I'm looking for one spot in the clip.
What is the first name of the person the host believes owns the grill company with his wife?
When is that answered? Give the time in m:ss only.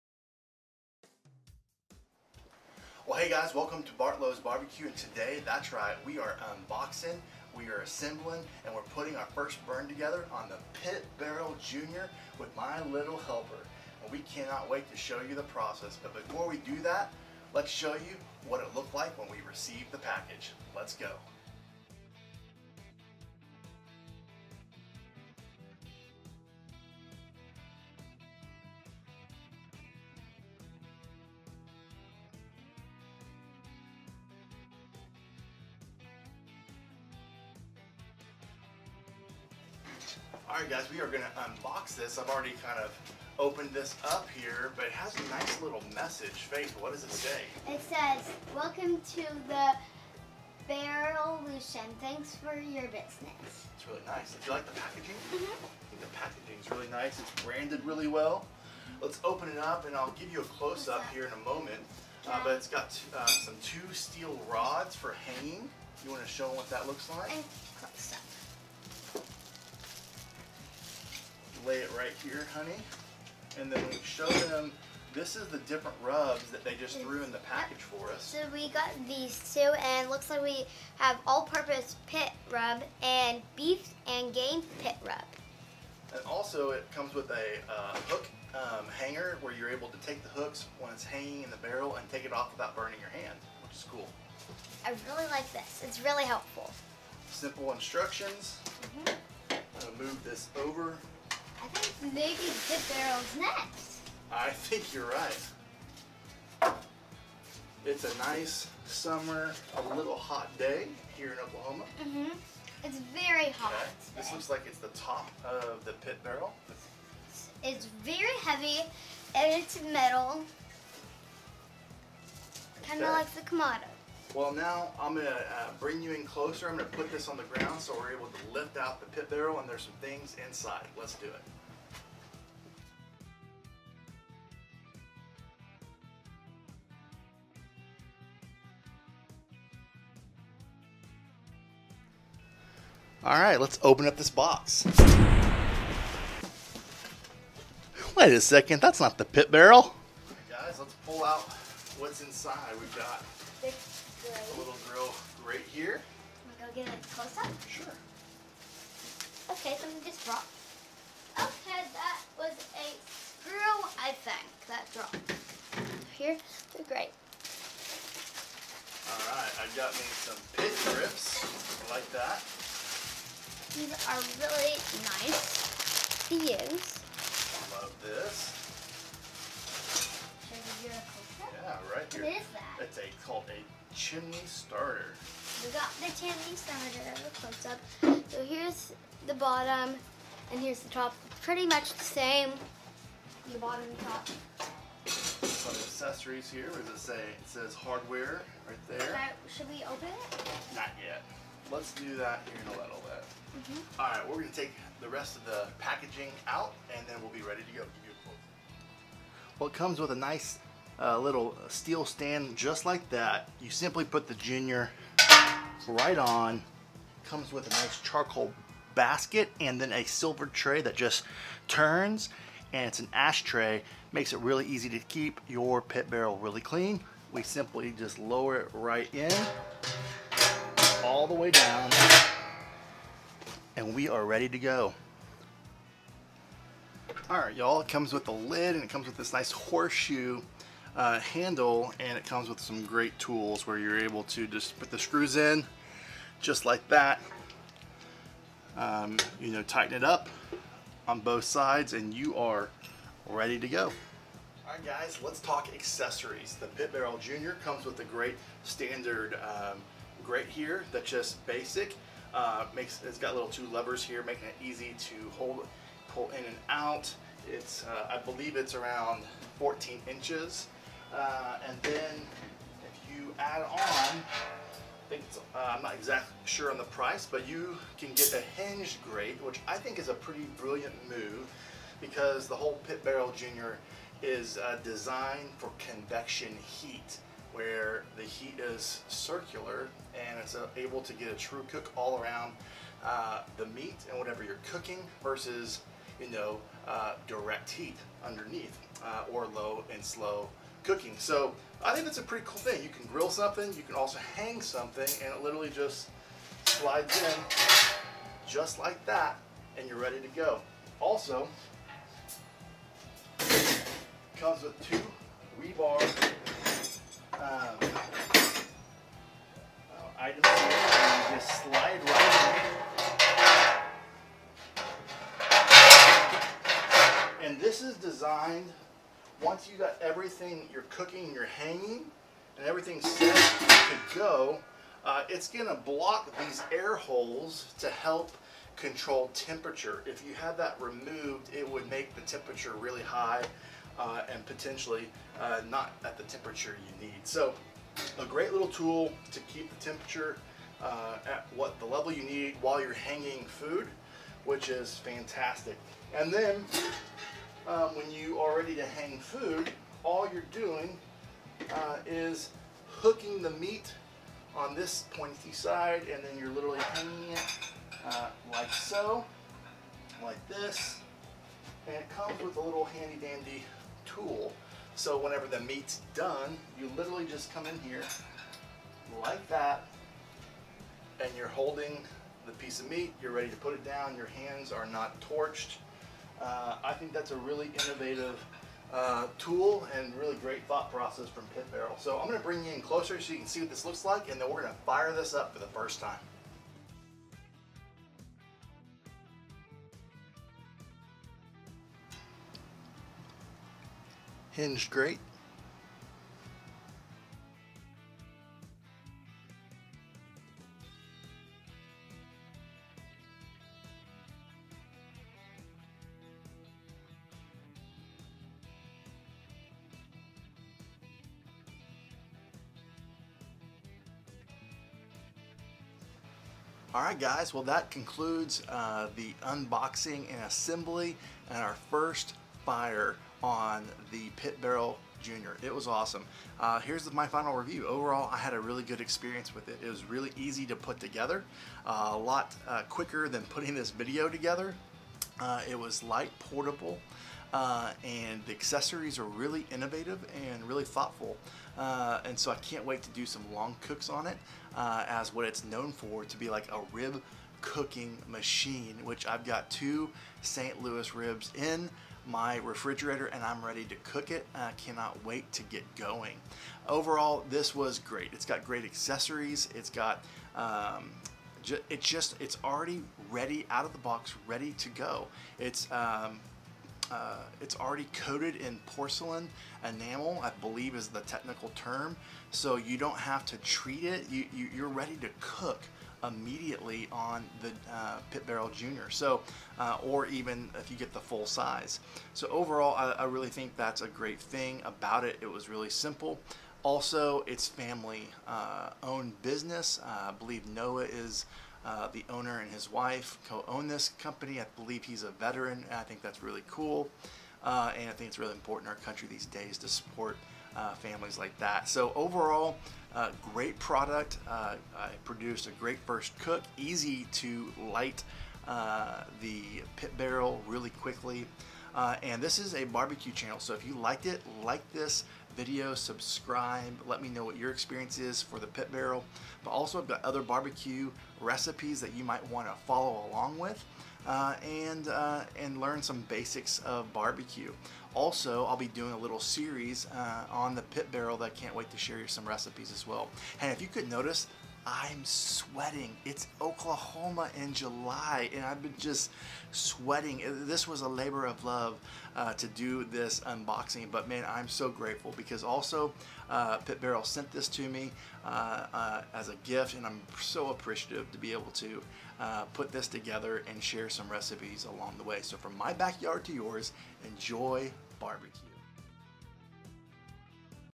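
8:20.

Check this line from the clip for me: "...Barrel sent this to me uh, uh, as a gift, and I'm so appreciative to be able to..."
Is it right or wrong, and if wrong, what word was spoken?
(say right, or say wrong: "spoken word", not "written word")
right.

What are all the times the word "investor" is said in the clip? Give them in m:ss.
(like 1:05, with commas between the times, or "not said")
not said.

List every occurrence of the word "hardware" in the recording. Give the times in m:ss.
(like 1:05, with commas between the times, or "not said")
3:17.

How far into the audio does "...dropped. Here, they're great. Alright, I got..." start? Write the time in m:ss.
2:44.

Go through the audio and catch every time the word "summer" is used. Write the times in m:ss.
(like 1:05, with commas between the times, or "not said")
1:48.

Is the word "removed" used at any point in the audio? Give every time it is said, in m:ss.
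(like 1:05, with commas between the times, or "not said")
5:40.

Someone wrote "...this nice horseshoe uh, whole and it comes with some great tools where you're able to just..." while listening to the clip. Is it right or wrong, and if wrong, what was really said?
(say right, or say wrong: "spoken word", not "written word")
wrong: "handle", not "whole".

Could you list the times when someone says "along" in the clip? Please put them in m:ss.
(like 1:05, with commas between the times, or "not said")
8:53, 9:24.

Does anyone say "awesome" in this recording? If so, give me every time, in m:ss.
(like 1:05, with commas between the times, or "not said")
7:15.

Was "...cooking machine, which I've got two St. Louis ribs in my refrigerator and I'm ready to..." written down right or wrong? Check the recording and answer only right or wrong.
right.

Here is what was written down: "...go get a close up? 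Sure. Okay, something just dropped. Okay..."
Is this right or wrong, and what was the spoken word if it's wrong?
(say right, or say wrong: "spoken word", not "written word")
right.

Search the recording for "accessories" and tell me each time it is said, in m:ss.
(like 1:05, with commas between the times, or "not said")
3:15, 4:15, 7:28, 7:48.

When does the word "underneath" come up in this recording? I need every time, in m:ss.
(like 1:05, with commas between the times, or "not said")
4:58.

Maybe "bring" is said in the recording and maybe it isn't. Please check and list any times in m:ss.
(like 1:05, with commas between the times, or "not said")
2:05, 6:32.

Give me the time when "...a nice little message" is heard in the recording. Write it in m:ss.
0:45.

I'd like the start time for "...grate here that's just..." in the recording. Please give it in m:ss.
4:20.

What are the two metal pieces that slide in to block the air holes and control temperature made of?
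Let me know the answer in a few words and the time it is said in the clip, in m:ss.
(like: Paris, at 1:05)
Rebar, at 5:15.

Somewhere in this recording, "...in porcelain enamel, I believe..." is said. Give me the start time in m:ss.
7:58.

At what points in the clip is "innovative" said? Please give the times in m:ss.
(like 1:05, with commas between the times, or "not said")
6:27, 7:29.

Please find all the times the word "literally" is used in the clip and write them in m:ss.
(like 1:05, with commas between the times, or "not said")
5:05, 6:06, 6:16.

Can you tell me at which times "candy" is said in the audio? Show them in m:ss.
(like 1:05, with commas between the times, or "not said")
not said.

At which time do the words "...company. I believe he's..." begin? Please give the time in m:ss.
8:24.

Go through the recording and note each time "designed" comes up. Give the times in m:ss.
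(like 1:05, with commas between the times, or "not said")
4:44, 5:27.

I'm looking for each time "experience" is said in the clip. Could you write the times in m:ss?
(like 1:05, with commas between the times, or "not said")
7:18, 8:47.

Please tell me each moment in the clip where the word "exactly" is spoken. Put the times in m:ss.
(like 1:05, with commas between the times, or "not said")
4:35.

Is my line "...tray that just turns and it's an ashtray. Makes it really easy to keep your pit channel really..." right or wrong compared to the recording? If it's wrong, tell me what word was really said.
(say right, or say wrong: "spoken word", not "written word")
wrong: "barrel", not "channel".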